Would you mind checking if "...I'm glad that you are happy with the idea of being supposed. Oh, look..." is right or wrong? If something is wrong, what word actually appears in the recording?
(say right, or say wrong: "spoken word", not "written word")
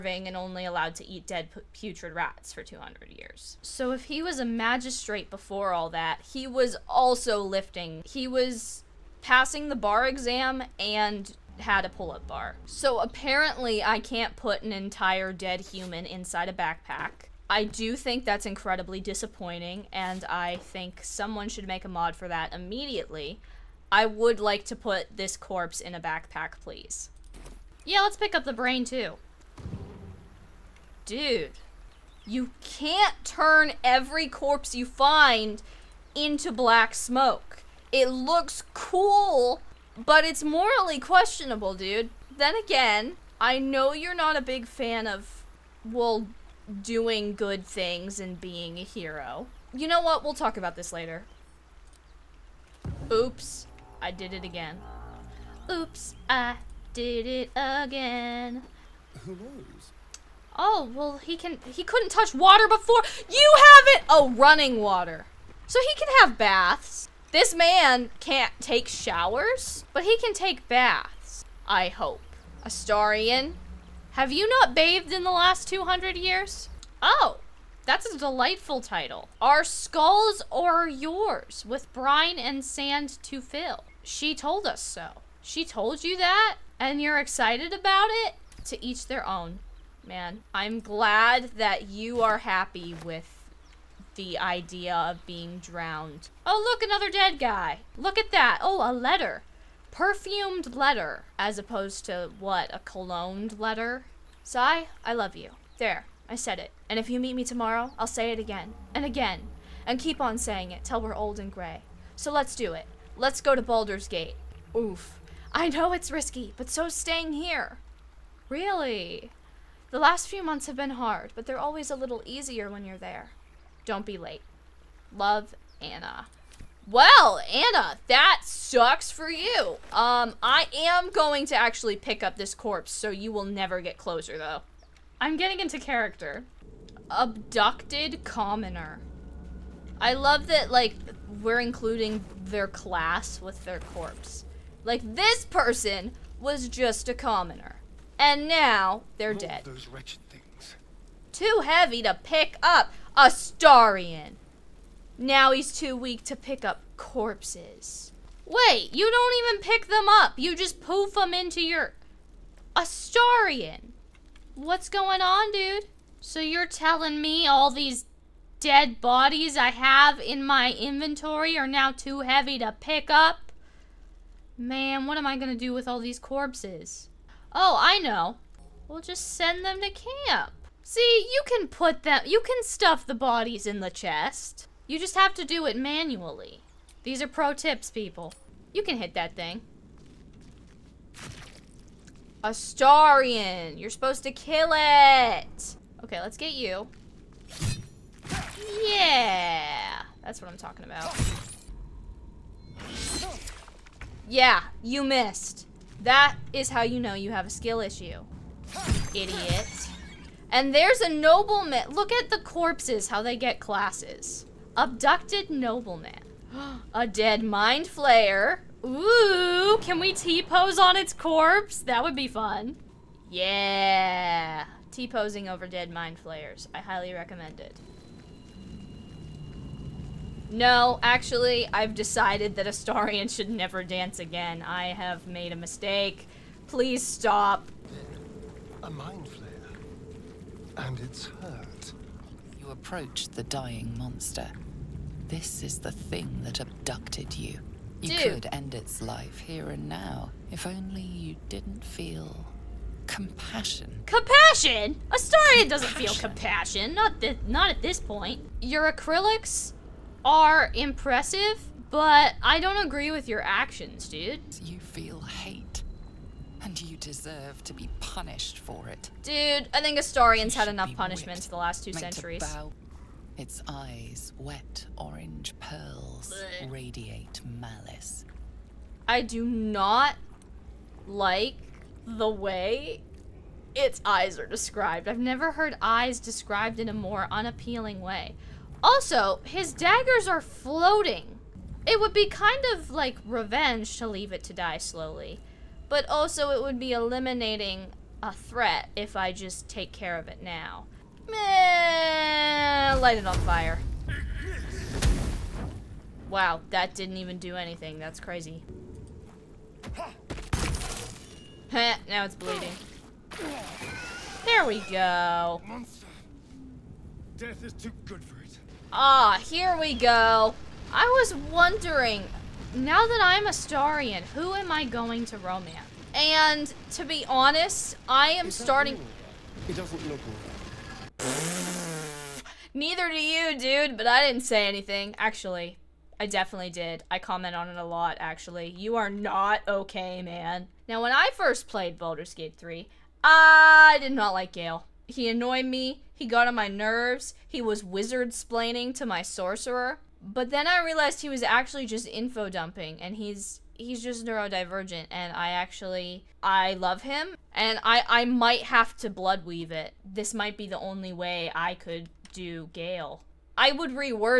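wrong: "drowned", not "supposed".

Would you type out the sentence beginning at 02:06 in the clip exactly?
Well, Anna, that sucks for you.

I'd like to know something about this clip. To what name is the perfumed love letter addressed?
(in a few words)
Sai.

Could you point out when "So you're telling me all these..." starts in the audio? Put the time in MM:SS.
02:46.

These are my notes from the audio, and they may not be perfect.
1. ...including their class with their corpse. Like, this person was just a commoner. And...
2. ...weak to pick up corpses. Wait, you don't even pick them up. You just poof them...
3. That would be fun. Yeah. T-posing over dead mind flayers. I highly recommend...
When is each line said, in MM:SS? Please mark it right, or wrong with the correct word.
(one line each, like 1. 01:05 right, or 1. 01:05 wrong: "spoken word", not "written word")
1. 02:21 right
2. 02:35 right
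3. 03:41 right.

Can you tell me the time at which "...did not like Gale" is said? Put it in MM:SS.
05:44.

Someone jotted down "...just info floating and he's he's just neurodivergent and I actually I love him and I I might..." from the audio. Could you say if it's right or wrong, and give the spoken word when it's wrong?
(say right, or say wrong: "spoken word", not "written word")
wrong: "dumping", not "floating".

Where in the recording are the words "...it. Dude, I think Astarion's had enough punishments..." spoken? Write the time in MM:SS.
04:28.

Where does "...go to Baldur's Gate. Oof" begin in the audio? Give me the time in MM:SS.
01:53.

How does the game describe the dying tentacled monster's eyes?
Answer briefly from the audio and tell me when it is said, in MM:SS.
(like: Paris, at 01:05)
Wet orange pearls, at 04:34.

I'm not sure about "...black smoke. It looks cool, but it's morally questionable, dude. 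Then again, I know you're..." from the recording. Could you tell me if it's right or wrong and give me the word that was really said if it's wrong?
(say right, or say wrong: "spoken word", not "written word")
right.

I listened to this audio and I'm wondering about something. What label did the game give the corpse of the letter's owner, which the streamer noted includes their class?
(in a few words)
Abducted commoner.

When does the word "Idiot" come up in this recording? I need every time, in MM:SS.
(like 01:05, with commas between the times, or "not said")
03:29.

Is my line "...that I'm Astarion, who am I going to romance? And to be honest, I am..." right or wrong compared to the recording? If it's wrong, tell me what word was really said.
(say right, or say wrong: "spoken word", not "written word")
right.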